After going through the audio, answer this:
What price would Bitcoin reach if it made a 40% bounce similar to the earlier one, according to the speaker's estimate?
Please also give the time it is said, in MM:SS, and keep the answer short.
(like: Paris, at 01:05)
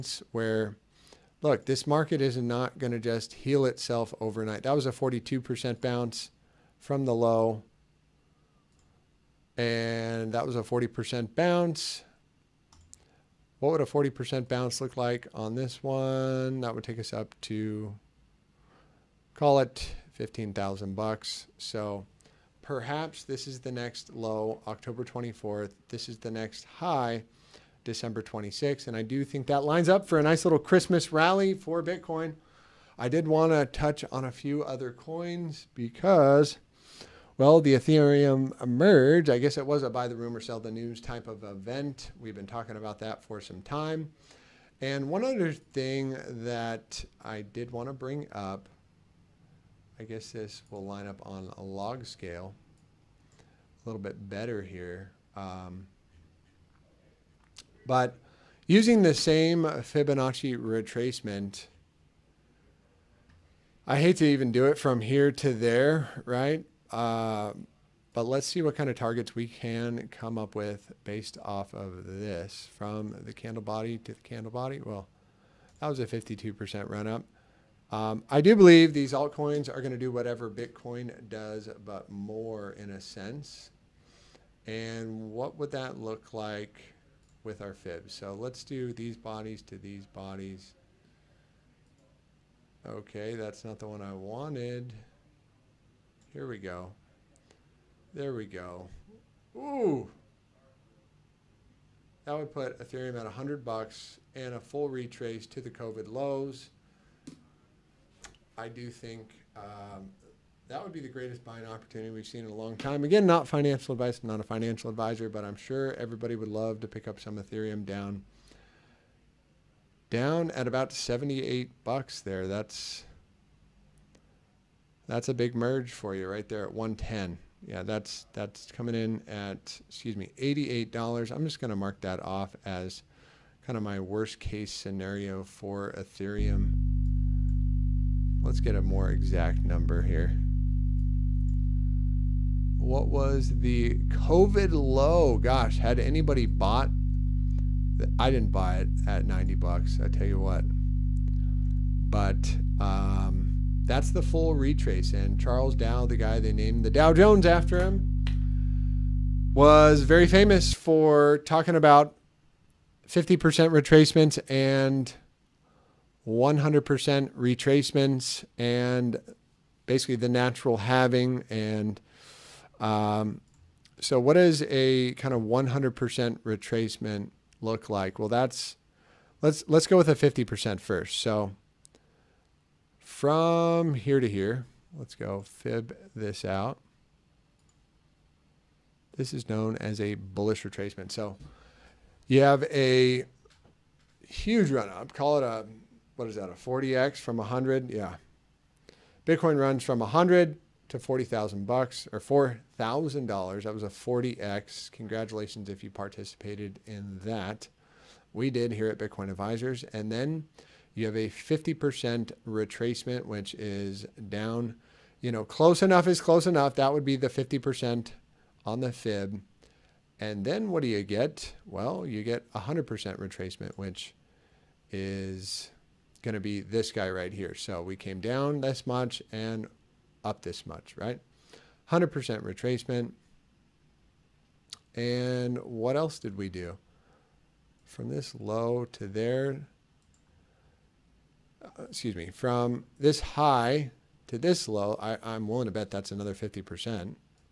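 $15,000, at 00:20.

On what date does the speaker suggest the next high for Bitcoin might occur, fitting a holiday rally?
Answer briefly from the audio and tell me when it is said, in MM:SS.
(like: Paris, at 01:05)
December 26th, at 00:27.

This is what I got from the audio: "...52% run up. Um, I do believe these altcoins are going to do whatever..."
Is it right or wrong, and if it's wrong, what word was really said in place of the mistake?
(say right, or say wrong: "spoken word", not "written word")
right.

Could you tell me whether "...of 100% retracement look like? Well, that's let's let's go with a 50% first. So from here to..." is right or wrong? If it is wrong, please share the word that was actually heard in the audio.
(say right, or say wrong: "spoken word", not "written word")
right.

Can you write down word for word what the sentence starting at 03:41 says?
Well, you get 100% retracement, which is going to be this guy right here.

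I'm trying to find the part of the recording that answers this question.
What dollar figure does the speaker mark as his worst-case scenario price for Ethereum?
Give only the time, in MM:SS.
02:10.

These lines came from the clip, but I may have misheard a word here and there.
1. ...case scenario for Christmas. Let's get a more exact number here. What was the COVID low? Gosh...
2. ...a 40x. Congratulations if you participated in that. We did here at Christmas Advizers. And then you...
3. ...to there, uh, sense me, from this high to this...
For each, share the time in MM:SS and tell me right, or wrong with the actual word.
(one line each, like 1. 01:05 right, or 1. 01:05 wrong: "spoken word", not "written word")
1. 02:14 wrong: "Ethereum", not "Christmas"
2. 03:23 wrong: "Bitcoin", not "Christmas"
3. 03:58 wrong: "excuse", not "sense".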